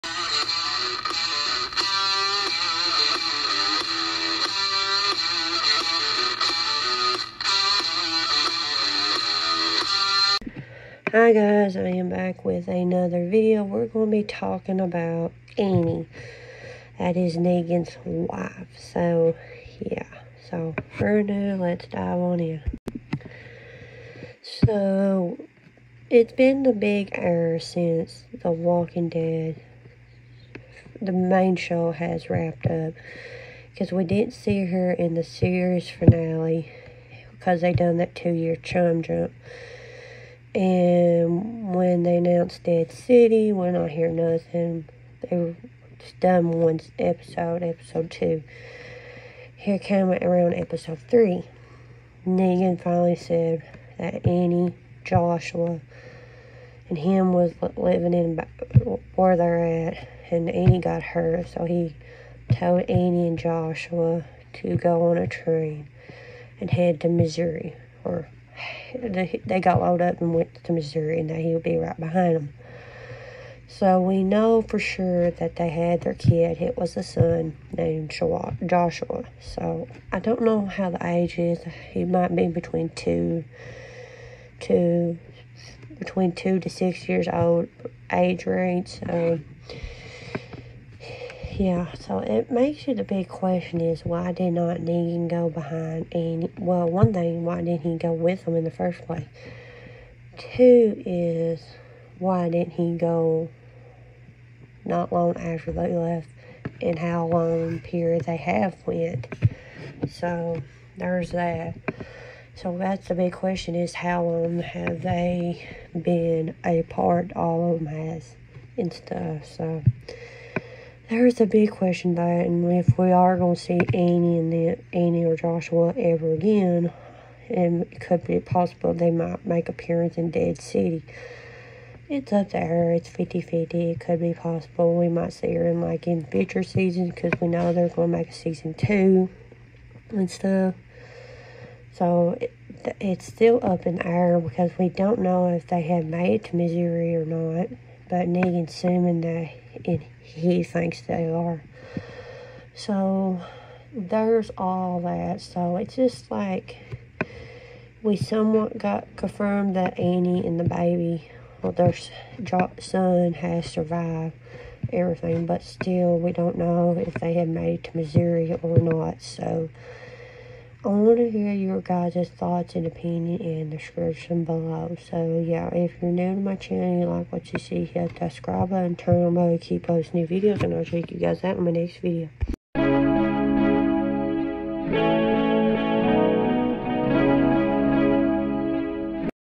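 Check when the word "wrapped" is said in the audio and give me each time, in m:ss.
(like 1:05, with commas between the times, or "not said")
0:32.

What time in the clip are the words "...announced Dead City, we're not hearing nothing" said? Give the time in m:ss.
0:42.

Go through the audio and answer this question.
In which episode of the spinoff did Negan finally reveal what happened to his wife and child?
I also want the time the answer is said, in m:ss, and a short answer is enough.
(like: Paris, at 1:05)
Episode 3, at 0:50.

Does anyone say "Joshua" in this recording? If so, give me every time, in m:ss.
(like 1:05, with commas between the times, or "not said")
0:55, 1:03, 1:18, 2:05.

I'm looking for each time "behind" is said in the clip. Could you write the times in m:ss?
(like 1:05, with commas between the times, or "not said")
1:11, 1:35.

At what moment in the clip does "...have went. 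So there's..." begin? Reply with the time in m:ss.
1:48.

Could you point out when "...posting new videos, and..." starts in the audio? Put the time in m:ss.
2:59.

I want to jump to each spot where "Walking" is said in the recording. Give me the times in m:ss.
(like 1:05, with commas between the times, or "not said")
0:28.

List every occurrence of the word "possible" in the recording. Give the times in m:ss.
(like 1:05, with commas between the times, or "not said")
2:08, 2:14.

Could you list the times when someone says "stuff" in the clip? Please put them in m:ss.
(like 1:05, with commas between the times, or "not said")
1:58, 2:20.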